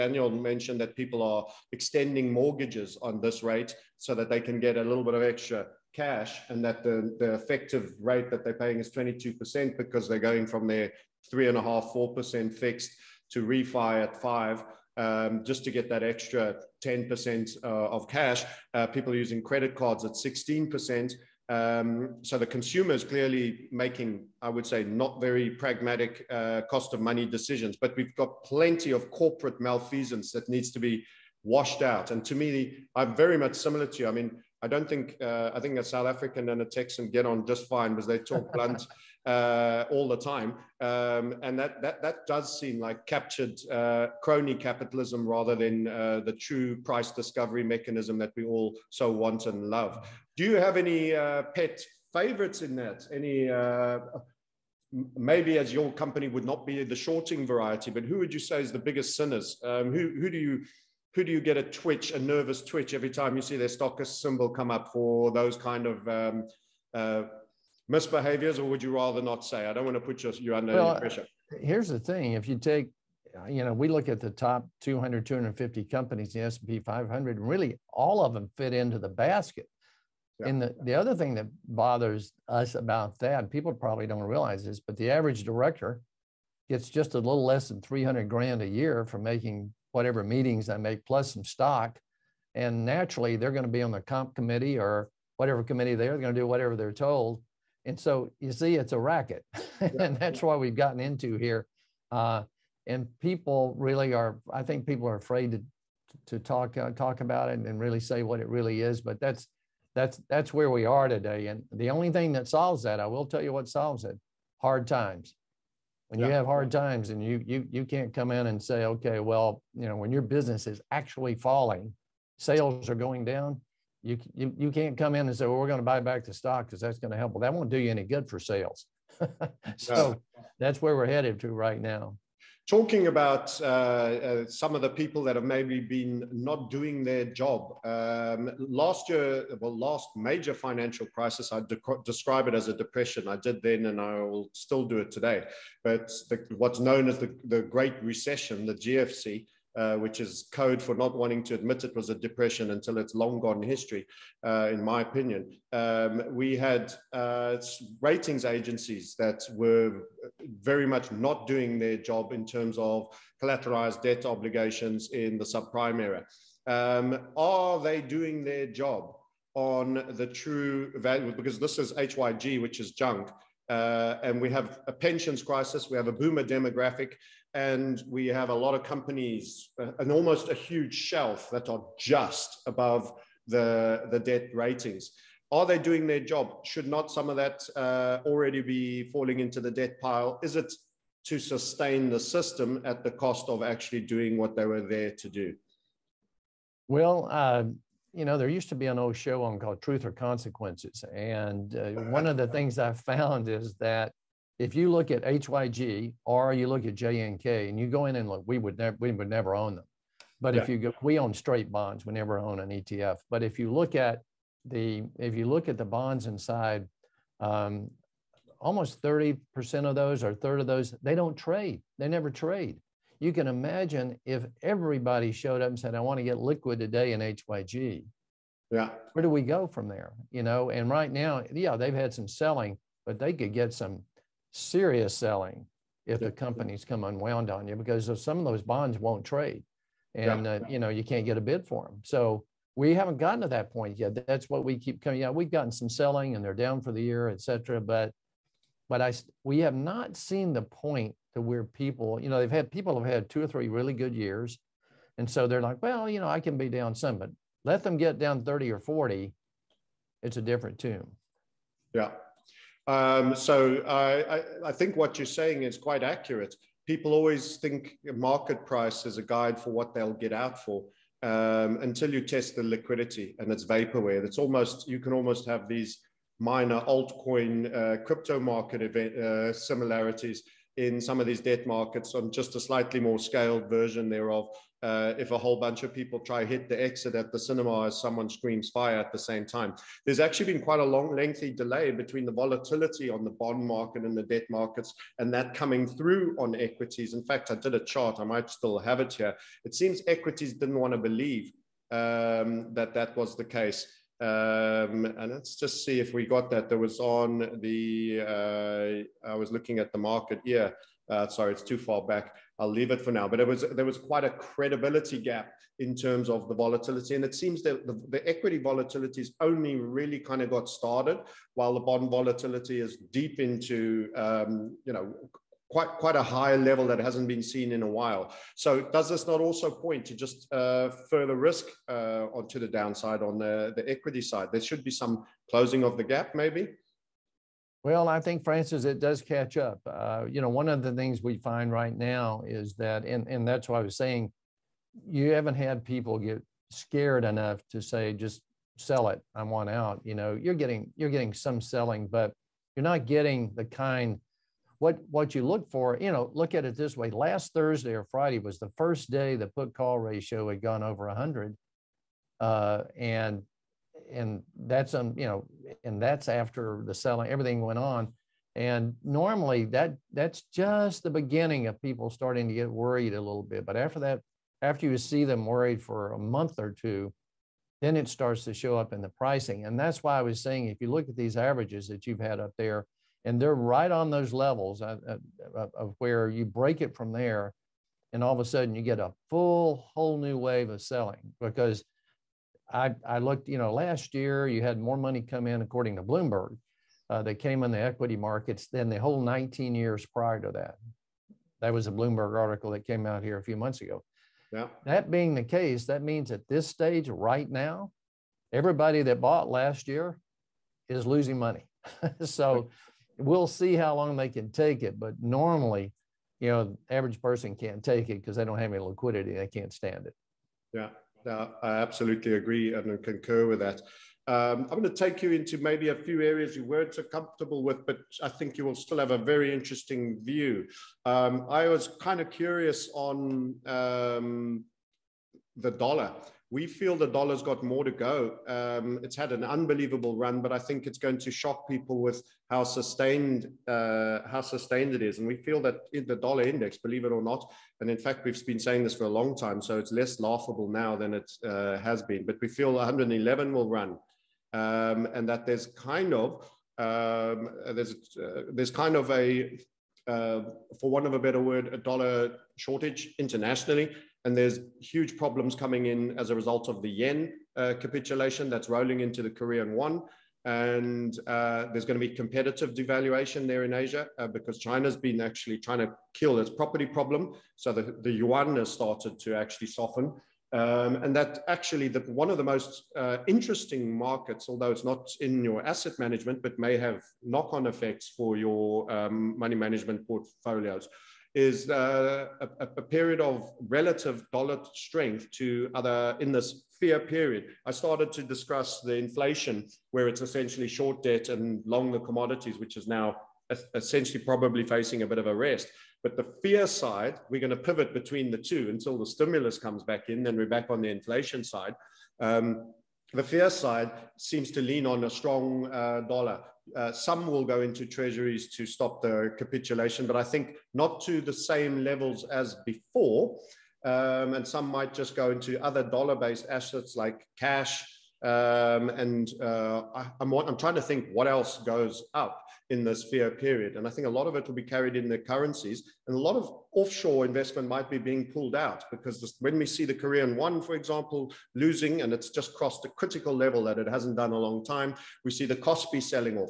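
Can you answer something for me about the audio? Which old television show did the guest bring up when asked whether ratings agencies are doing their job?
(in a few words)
Truth or Consequences.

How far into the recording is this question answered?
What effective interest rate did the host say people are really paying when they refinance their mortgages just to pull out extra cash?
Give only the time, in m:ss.
0:08.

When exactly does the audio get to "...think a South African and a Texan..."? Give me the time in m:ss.
0:35.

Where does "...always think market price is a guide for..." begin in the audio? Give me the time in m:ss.
4:27.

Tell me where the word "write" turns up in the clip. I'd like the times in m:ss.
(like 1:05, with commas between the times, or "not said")
not said.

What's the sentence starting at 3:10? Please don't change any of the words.
Is it to sustain the system at the cost of actually doing what they were there to do?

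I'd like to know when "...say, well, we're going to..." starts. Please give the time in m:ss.
2:05.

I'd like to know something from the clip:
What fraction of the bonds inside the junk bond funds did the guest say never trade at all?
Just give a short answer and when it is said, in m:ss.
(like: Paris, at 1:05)
a third, at 3:40.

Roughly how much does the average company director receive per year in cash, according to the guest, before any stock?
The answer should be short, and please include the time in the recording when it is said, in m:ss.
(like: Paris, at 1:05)
300 grand, at 1:27.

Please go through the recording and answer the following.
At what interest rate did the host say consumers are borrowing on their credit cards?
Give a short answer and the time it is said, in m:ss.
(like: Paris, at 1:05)
16%, at 0:20.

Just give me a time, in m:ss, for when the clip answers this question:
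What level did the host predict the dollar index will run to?
7:32.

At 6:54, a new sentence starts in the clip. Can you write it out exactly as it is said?
But normally, you know, average person can't take it because they don't have any liquidity.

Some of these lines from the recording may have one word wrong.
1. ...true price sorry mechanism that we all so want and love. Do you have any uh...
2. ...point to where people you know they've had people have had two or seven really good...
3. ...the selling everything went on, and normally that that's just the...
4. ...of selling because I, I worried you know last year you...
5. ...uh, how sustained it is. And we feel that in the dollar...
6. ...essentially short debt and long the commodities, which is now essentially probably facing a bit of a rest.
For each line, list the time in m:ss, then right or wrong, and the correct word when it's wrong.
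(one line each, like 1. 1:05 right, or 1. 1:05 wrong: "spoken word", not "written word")
1. 0:46 wrong: "discovery", not "sorry"
2. 4:10 wrong: "three", not "seven"
3. 6:06 right
4. 6:30 wrong: "looked", not "worried"
5. 7:23 right
6. 8:20 right.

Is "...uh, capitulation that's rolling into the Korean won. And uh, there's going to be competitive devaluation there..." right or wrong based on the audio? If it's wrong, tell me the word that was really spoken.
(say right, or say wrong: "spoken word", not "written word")
right.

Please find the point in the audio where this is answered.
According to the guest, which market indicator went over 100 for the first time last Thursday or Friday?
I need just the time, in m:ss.
5:59.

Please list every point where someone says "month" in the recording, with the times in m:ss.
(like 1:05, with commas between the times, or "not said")
6:16, 6:43.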